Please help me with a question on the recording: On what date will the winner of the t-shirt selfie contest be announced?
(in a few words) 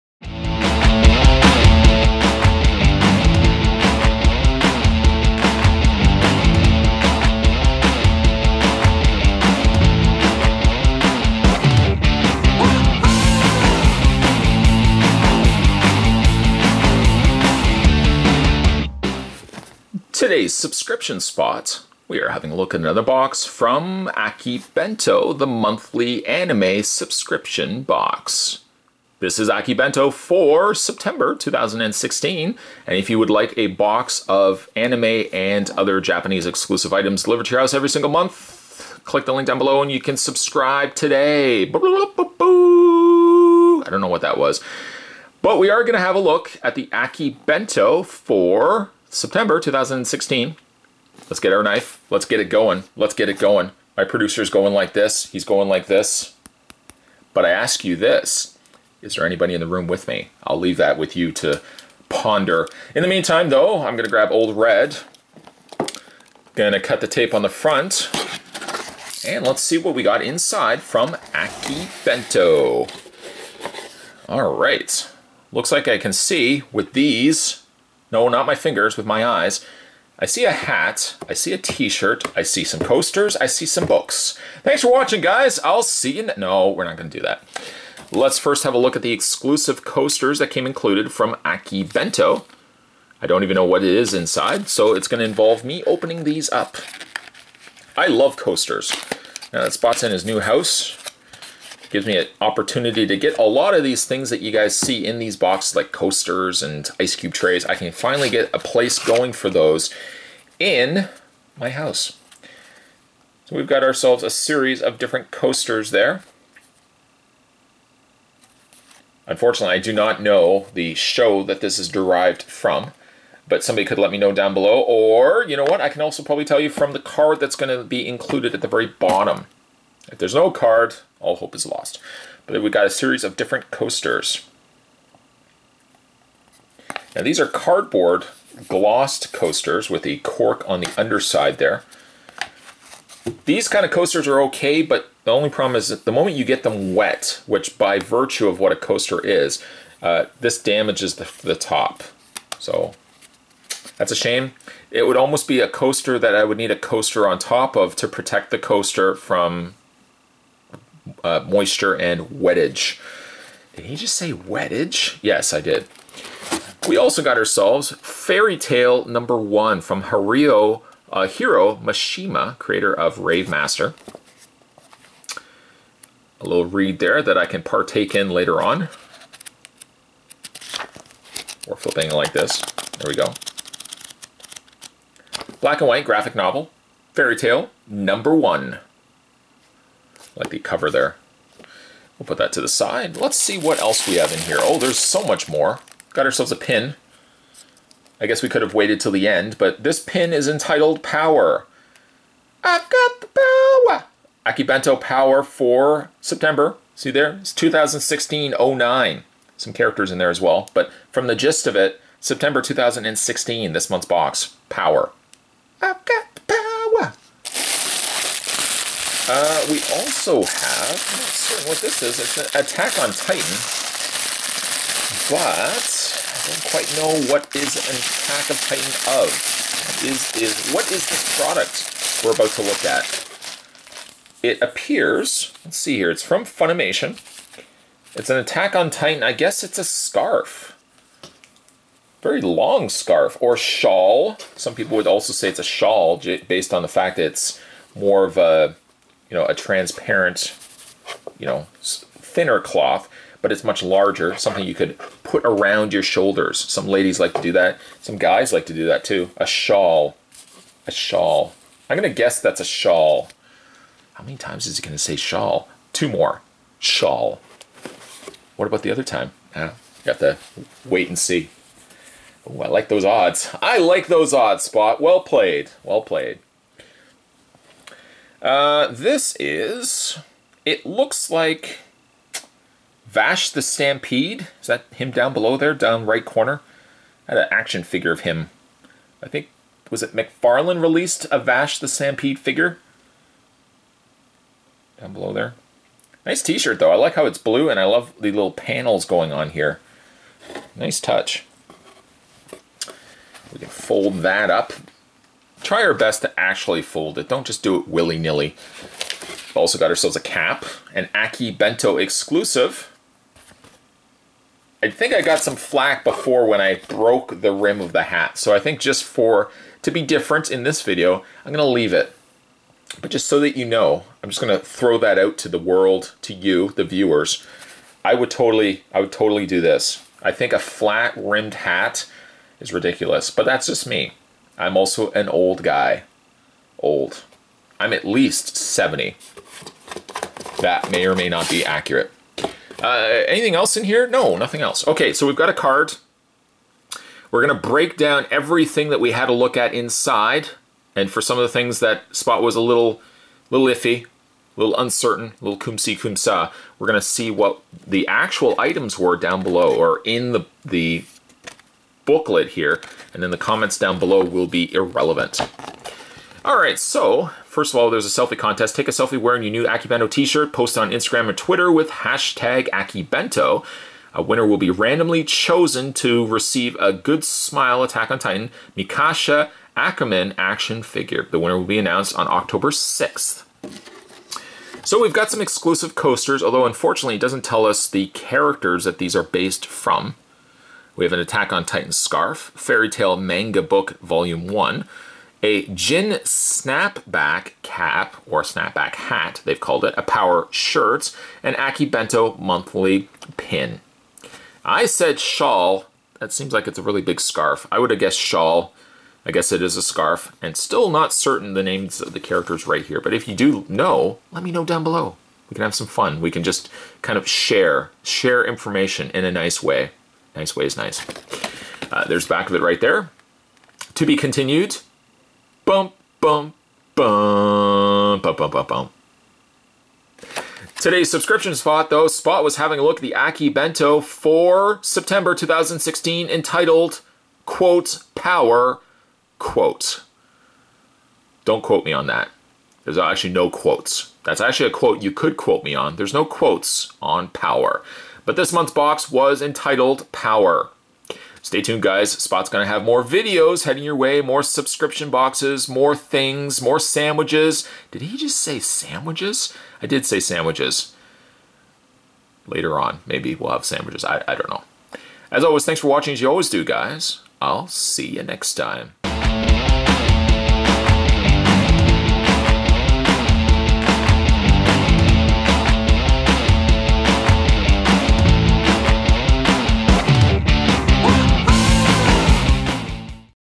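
October 6th.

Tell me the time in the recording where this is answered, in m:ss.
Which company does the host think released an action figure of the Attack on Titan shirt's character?
4:50.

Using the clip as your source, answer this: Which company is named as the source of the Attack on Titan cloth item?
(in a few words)
Funimation.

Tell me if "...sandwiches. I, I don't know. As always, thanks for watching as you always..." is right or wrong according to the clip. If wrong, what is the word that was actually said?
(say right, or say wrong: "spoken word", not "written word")
right.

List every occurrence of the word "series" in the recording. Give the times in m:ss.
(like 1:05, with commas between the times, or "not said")
1:54, 2:12.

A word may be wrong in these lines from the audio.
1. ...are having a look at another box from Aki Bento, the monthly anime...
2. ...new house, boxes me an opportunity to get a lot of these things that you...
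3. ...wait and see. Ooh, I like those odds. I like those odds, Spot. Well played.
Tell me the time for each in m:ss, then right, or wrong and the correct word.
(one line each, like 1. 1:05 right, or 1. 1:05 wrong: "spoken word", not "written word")
1. 0:22 right
2. 1:40 wrong: "gives", not "boxes"
3. 4:30 right.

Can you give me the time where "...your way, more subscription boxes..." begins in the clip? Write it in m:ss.
7:33.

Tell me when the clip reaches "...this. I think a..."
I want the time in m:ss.
5:29.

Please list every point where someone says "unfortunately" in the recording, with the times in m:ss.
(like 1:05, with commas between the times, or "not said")
1:59, 6:26.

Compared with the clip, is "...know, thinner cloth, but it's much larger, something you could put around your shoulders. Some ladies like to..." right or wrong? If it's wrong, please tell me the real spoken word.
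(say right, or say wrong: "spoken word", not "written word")
right.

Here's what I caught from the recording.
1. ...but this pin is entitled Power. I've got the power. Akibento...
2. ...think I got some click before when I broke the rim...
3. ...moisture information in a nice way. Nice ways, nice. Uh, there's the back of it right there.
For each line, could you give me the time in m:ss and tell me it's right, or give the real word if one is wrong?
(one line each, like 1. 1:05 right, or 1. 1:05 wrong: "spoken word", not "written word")
1. 3:19 right
2. 5:14 wrong: "flack", not "click"
3. 6:58 wrong: "share", not "moisture".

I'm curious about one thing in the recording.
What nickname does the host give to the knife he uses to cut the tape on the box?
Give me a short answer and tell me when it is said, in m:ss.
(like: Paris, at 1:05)
Old Red, at 1:04.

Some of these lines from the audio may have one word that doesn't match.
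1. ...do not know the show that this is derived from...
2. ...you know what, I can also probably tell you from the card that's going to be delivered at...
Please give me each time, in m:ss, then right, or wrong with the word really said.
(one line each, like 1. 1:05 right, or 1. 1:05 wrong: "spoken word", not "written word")
1. 1:59 right
2. 2:05 wrong: "included", not "delivered".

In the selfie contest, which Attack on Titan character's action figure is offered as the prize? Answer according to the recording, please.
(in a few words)
Mikasa Ackerman.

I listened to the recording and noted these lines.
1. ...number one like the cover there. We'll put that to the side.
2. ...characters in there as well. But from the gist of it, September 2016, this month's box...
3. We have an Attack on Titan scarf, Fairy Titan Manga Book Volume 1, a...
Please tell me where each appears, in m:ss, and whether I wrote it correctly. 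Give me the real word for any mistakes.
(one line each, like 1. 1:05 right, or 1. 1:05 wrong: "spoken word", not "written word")
1. 3:07 right
2. 3:29 right
3. 6:30 wrong: "Tail", not "Titan".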